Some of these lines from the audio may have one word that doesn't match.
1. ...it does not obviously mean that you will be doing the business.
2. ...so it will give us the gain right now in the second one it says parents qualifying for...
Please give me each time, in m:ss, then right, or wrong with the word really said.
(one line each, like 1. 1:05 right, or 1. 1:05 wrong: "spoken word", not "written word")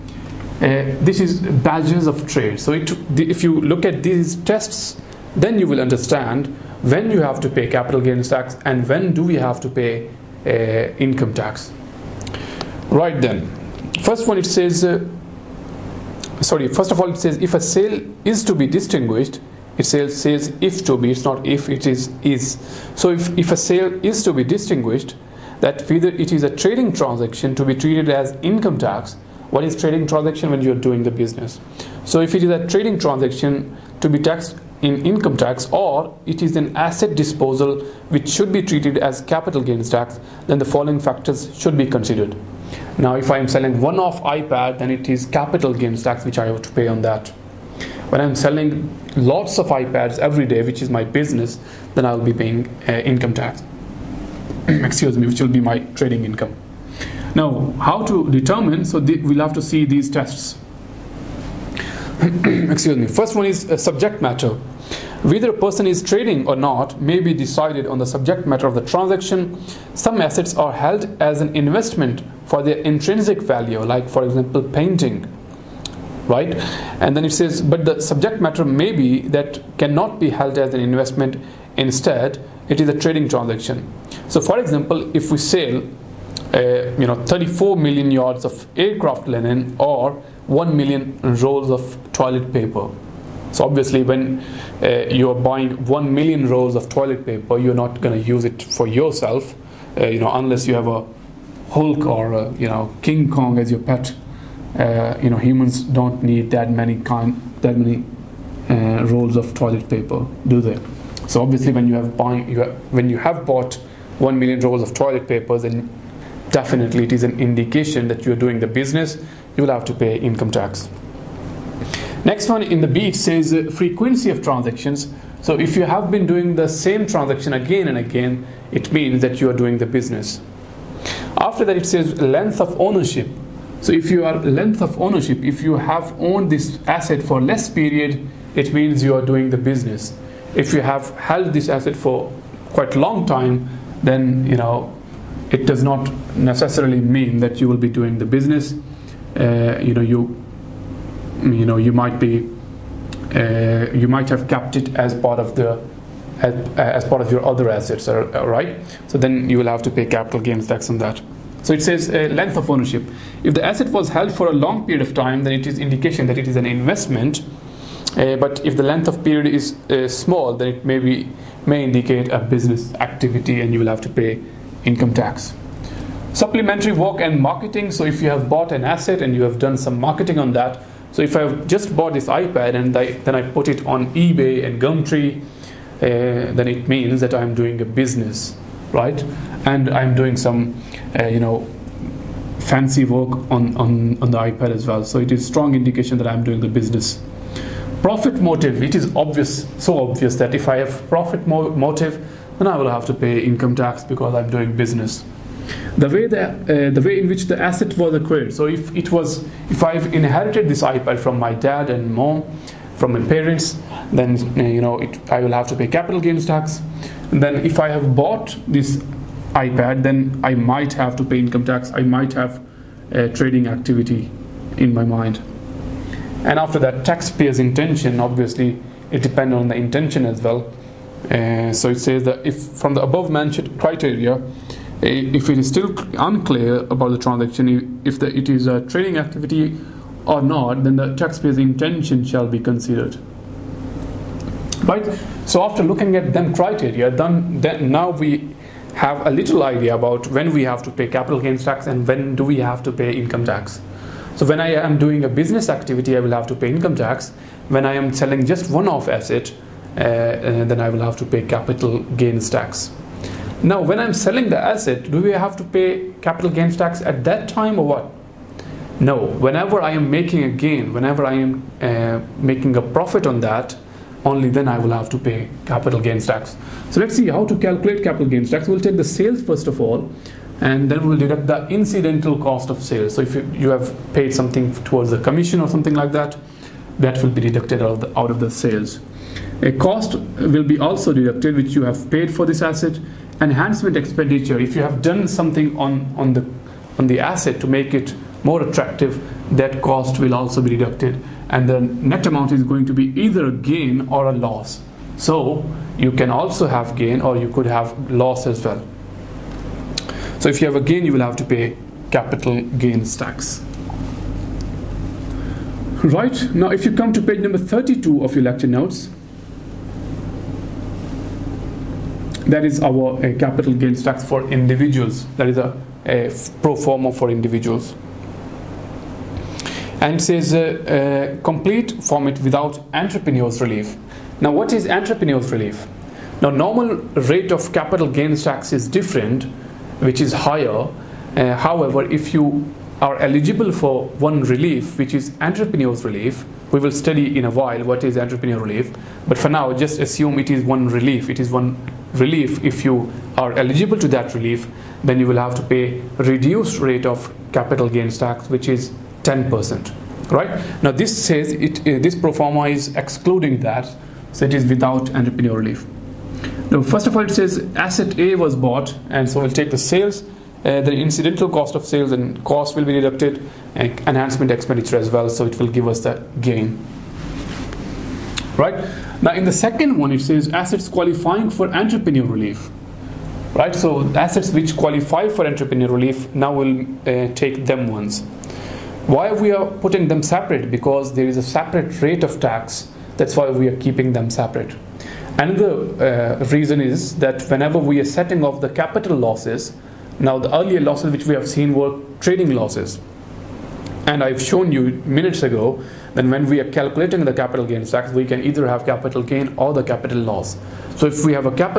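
1. 2:25 wrong: "necessarily", not "obviously"
2. 6:15 wrong: "assets", not "parents".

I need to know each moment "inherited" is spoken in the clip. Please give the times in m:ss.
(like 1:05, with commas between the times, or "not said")
3:30.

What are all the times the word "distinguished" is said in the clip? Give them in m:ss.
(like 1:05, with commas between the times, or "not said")
0:18, 0:24.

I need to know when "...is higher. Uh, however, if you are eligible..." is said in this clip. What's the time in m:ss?
5:40.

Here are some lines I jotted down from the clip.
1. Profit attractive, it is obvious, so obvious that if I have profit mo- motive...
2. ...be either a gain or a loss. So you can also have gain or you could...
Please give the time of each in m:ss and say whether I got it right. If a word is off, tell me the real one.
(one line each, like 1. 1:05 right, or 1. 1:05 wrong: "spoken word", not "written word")
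1. 3:18 wrong: "motive", not "attractive"
2. 5:02 right.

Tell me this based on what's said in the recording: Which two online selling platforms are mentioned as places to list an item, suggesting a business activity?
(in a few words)
eBay and Gumtree.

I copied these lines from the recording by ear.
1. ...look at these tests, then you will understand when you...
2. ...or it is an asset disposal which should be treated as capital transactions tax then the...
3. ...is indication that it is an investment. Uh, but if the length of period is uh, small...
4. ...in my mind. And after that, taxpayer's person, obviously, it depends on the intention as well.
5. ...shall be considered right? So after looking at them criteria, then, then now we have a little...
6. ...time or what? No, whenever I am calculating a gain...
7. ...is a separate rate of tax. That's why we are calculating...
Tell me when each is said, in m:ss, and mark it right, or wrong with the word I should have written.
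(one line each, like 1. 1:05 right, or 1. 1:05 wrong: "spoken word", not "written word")
1. 0:03 right
2. 0:35 wrong: "gains", not "transactions"
3. 2:45 right
4. 3:44 wrong: "intention", not "person"
5. 4:02 right
6. 4:27 wrong: "making", not "calculating"
7. 6:31 wrong: "keeping", not "calculating".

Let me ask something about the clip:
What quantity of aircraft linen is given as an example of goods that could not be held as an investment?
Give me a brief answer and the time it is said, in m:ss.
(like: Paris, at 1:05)
34 million yards, at 1:27.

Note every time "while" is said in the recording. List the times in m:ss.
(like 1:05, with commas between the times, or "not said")
5:47.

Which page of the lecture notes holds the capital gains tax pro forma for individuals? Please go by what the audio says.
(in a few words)
32.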